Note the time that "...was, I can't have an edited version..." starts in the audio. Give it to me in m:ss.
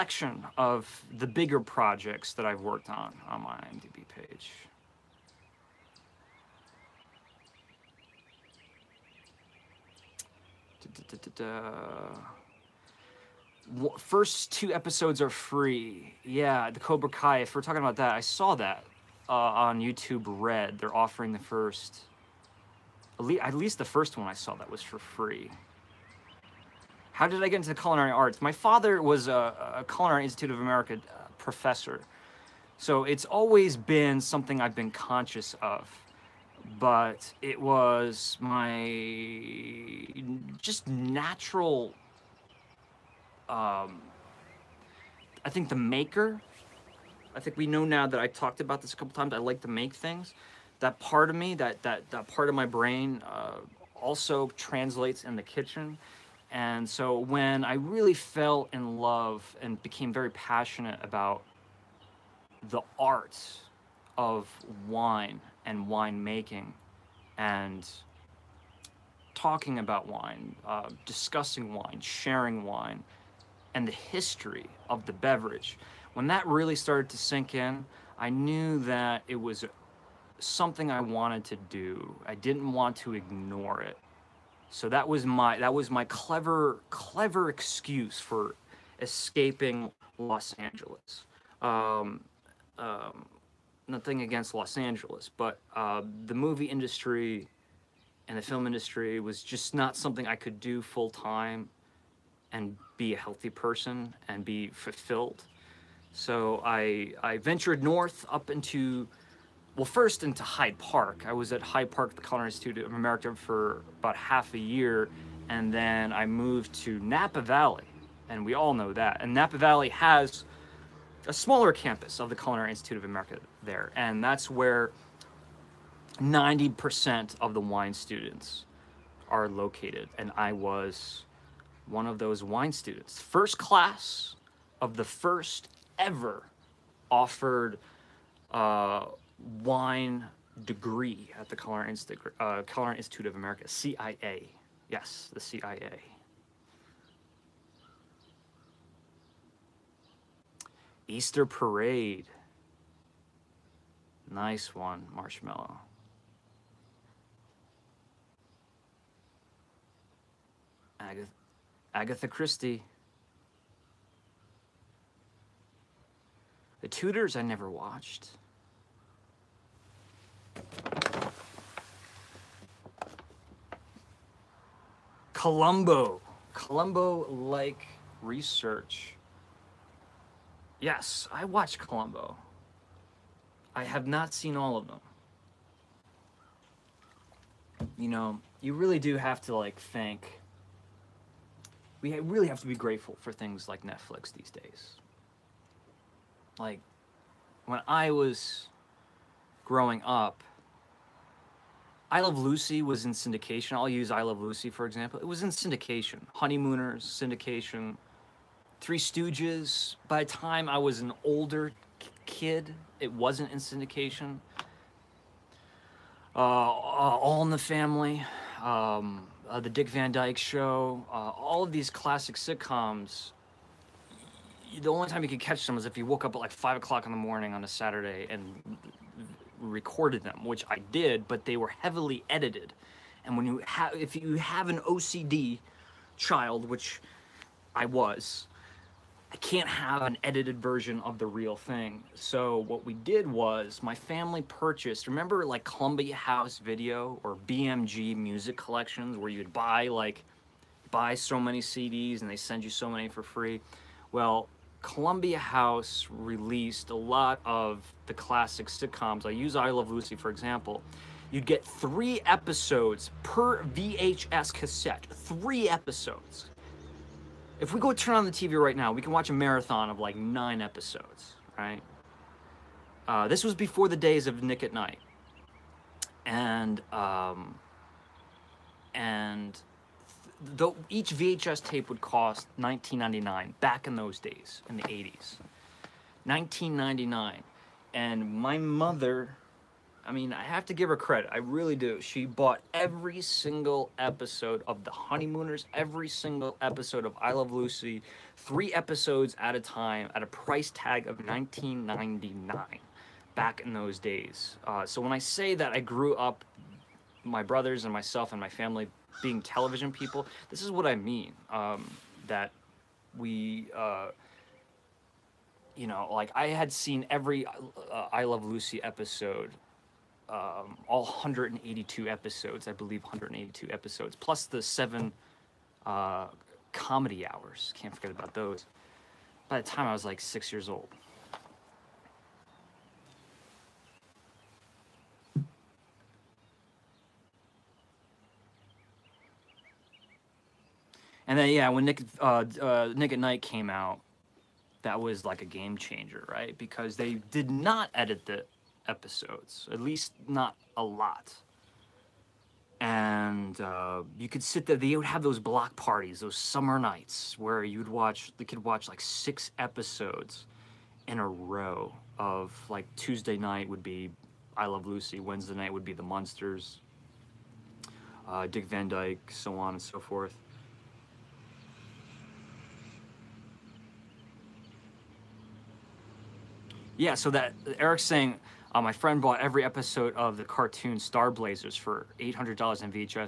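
3:57.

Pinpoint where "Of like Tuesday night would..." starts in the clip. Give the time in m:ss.
6:02.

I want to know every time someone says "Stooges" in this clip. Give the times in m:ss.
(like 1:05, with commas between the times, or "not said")
3:28.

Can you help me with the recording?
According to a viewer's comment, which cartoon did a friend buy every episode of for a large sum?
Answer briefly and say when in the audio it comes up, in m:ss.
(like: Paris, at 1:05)
Star Blazers, at 6:20.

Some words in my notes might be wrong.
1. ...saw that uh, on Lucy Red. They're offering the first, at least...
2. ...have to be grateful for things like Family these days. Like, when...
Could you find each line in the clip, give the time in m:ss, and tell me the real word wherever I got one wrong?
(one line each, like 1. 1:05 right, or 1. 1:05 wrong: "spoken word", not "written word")
1. 0:18 wrong: "YouTube", not "Lucy"
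2. 3:12 wrong: "Netflix", not "Family".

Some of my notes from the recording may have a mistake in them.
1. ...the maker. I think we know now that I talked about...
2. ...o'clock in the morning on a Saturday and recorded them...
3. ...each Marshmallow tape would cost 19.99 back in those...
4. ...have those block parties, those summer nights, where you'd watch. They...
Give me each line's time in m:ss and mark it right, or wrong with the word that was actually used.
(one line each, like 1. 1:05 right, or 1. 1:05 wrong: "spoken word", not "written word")
1. 0:45 right
2. 3:46 right
3. 4:40 wrong: "VHS", not "Marshmallow"
4. 5:55 right.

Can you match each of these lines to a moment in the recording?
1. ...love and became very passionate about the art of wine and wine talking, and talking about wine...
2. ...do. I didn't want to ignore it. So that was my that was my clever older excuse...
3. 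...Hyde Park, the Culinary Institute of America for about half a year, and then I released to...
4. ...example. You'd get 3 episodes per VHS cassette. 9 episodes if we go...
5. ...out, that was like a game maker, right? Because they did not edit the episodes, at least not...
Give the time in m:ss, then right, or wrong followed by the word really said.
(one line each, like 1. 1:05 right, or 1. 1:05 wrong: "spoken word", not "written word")
1. 0:58 wrong: "making", not "talking"
2. 1:21 wrong: "clever", not "older"
3. 1:51 wrong: "moved", not "released"
4. 4:20 wrong: "3", not "9"
5. 5:43 wrong: "changer", not "maker".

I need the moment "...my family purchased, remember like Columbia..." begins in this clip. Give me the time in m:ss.
4:03.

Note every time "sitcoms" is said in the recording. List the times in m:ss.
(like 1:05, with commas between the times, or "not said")
3:42, 4:18.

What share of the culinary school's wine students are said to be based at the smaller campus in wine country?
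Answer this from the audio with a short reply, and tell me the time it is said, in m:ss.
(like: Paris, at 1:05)
90%, at 2:06.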